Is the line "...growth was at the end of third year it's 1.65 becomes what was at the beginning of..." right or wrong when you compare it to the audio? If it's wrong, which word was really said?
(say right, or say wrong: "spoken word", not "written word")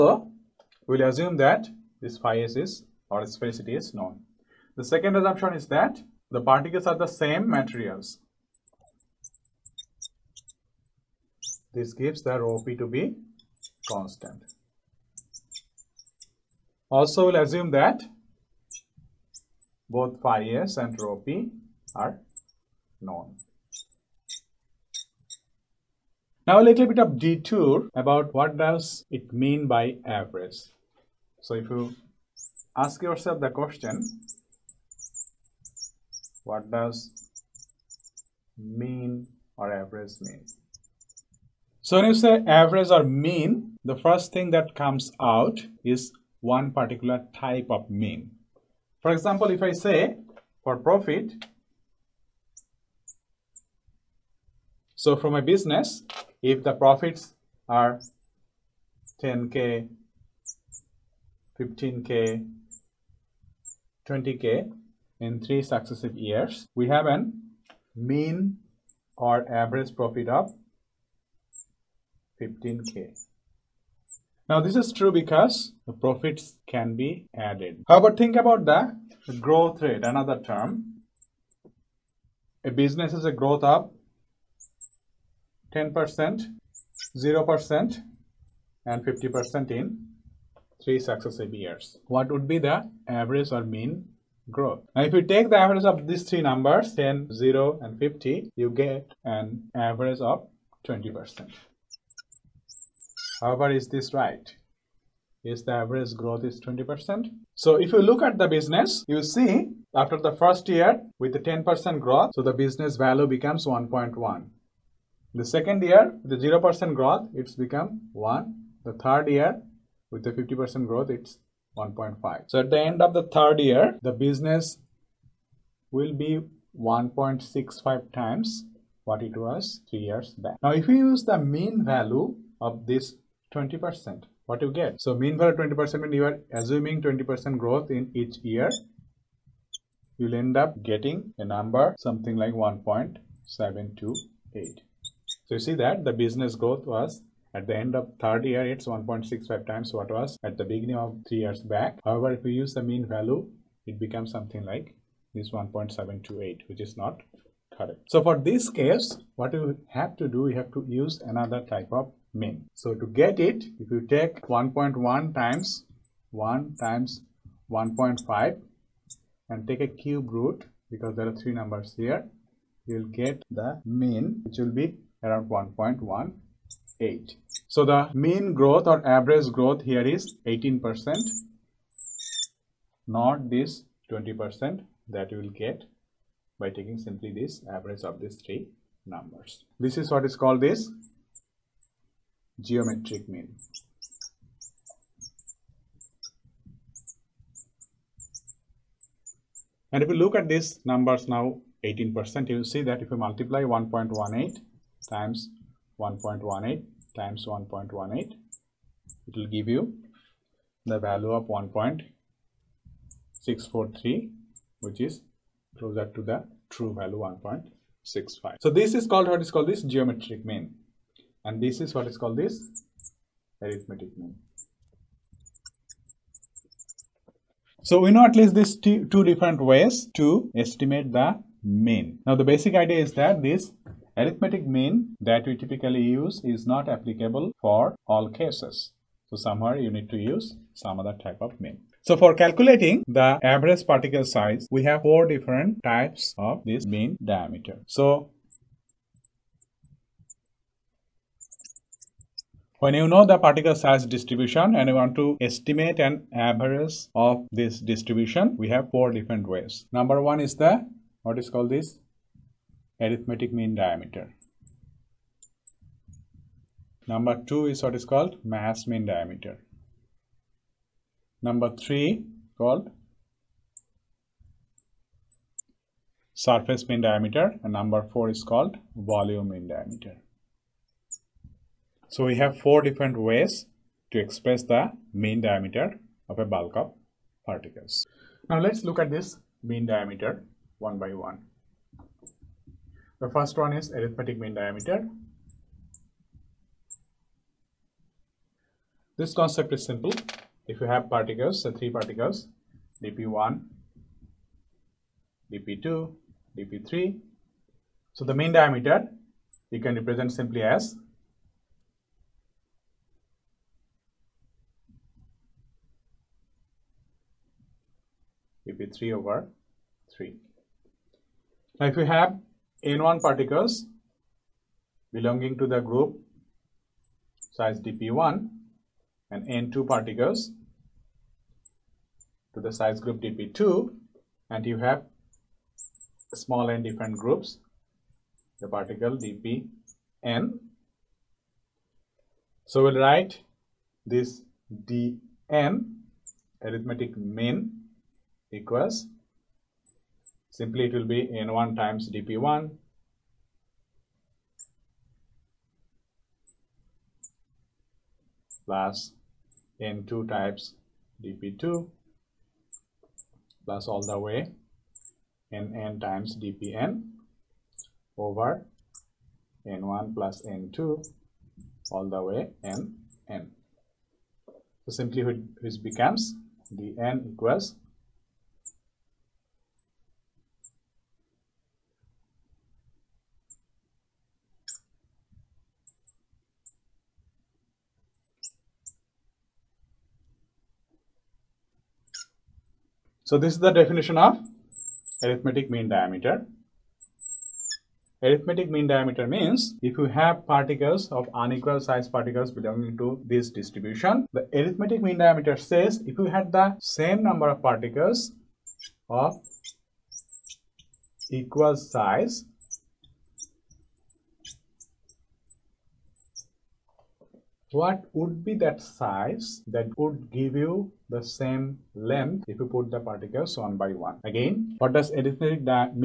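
wrong: "times", not "becomes".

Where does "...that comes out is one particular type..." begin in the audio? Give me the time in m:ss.
0:44.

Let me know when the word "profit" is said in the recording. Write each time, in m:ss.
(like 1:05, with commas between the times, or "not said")
0:50, 0:56, 1:09, 1:15.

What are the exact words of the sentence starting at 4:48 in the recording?
Now let's look at this mean diameter one by one.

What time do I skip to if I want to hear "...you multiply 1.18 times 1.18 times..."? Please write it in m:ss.
3:23.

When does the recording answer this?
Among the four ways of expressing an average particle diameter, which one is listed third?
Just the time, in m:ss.
4:36.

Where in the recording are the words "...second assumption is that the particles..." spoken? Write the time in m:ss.
0:04.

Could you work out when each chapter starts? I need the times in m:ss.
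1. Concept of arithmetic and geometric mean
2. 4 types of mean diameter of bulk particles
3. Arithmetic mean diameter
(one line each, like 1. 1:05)
1. 0:27
2. 4:01
3. 4:48.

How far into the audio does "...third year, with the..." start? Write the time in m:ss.
1:58.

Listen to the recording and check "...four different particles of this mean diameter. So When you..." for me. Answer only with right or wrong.
wrong.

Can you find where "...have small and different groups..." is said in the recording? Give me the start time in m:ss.
5:34.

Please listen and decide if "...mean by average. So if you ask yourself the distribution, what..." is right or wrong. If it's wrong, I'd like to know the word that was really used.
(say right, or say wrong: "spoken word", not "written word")
wrong: "question", not "distribution".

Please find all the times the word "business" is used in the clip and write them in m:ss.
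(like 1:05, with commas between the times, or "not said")
0:55, 1:22, 1:48, 1:52, 2:04, 2:26.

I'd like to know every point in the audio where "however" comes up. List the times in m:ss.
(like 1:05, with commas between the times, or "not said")
1:17, 1:43, 2:32.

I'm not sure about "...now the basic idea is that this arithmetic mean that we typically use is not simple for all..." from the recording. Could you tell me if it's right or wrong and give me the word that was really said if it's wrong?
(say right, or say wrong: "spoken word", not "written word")
wrong: "applicable", not "simple".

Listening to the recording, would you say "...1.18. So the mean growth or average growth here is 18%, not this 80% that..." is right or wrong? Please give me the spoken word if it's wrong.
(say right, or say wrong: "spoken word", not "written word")
wrong: "20", not "80".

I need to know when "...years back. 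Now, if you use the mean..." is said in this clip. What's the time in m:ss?
2:09.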